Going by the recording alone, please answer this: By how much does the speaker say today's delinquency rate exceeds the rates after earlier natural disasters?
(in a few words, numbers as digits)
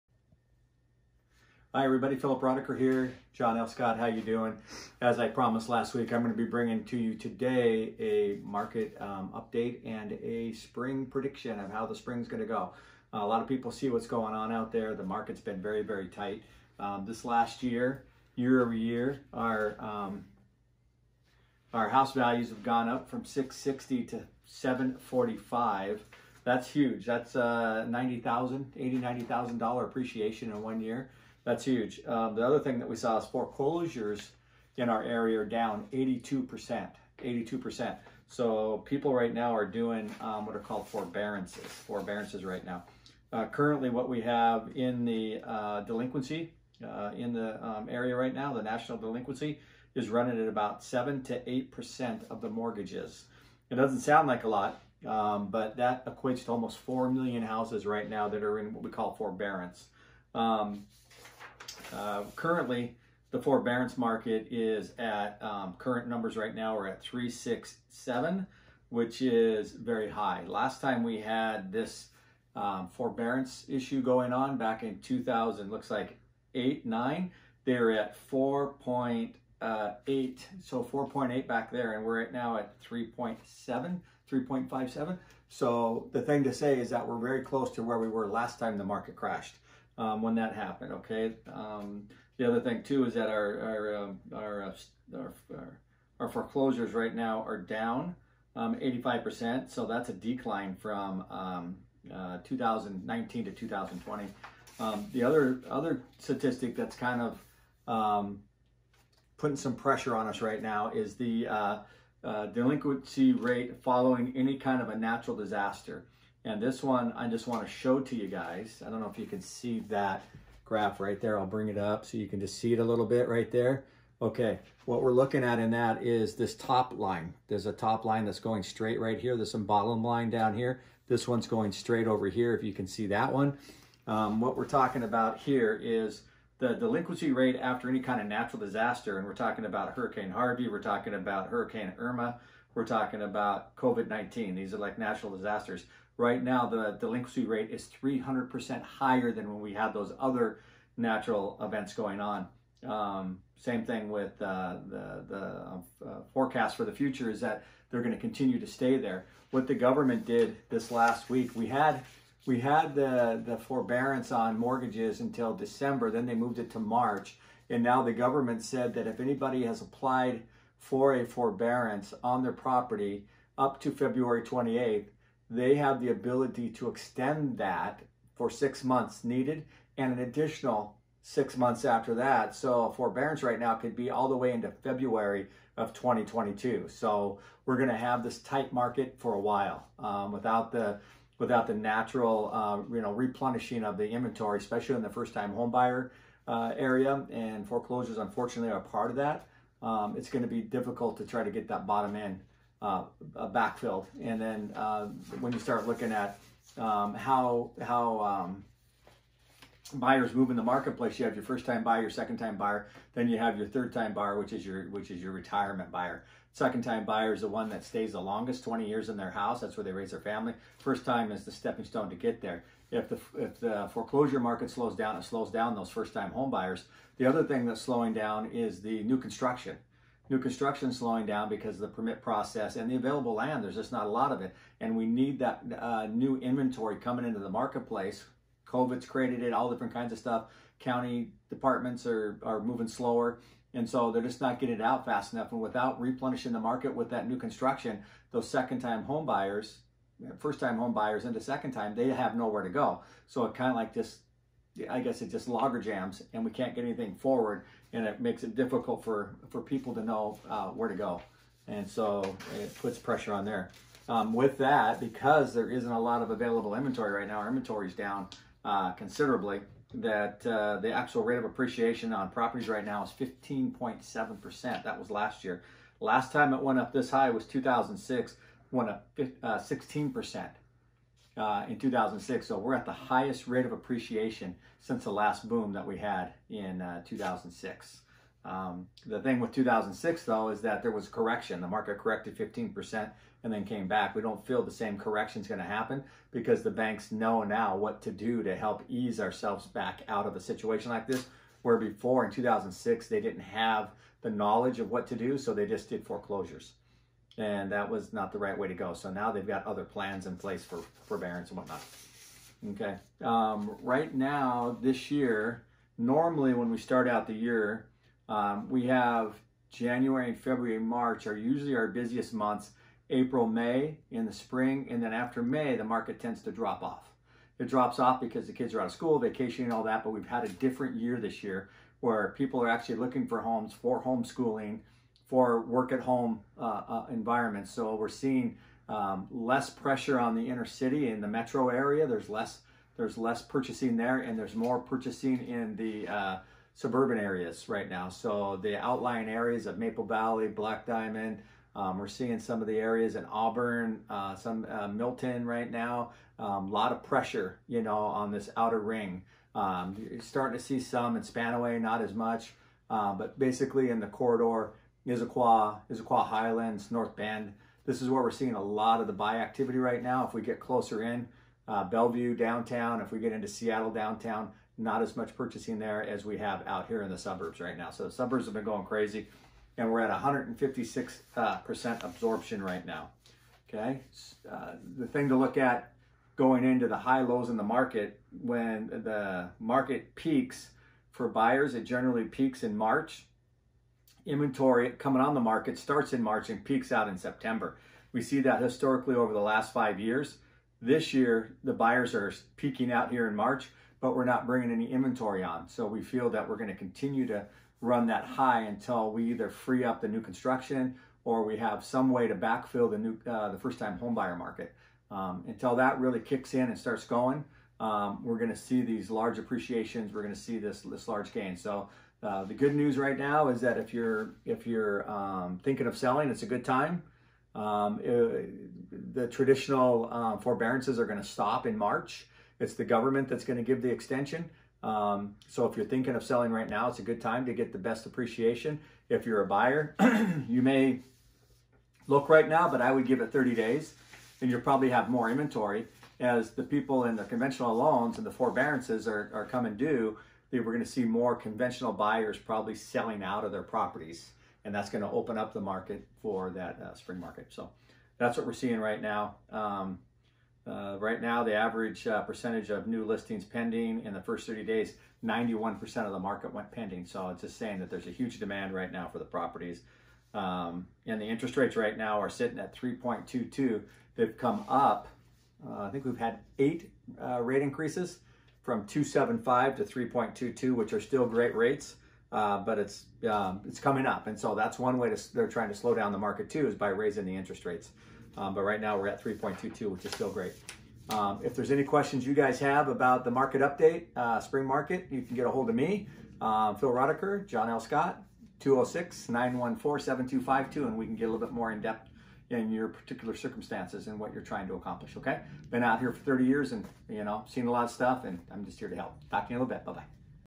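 300%.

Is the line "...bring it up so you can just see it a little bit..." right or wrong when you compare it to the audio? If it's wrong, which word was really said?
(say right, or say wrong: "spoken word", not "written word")
right.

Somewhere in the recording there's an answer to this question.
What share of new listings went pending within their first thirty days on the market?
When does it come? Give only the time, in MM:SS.
07:45.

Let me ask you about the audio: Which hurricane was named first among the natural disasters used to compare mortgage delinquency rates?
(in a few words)
Hurricane Harvey.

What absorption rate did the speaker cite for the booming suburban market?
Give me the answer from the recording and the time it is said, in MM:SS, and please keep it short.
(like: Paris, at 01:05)
156%, at 06:20.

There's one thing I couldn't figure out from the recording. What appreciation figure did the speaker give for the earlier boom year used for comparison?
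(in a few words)
16%.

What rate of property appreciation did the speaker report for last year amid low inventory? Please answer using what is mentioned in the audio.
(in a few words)
15.7%.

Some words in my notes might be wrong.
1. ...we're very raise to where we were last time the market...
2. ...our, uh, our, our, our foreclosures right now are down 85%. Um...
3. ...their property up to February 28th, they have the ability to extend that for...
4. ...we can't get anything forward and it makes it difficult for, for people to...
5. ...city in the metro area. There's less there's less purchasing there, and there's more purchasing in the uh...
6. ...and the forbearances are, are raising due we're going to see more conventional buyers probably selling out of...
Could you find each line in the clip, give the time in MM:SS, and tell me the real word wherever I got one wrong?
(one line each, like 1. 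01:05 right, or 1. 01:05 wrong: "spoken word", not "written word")
1. 01:27 wrong: "close", not "raise"
2. 01:34 right
3. 02:52 right
4. 04:16 right
5. 05:40 right
6. 07:28 wrong: "coming", not "raising".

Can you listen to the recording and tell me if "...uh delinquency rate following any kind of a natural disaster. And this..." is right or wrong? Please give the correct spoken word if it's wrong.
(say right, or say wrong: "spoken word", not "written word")
right.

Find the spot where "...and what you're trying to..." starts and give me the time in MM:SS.
08:24.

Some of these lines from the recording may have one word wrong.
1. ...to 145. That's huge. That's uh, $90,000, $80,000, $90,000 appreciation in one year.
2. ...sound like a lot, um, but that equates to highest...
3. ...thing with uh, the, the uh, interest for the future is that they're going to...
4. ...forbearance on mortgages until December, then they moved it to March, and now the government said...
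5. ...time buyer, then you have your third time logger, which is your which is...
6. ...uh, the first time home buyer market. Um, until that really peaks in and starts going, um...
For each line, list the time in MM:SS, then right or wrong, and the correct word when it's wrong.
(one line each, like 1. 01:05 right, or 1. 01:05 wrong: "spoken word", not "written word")
1. 00:24 wrong: "745", not "145"
2. 00:54 wrong: "almost", not "highest"
3. 02:33 wrong: "forecast", not "interest"
4. 02:43 right
5. 03:32 wrong: "buyer", not "logger"
6. 06:53 wrong: "kicks", not "peaks".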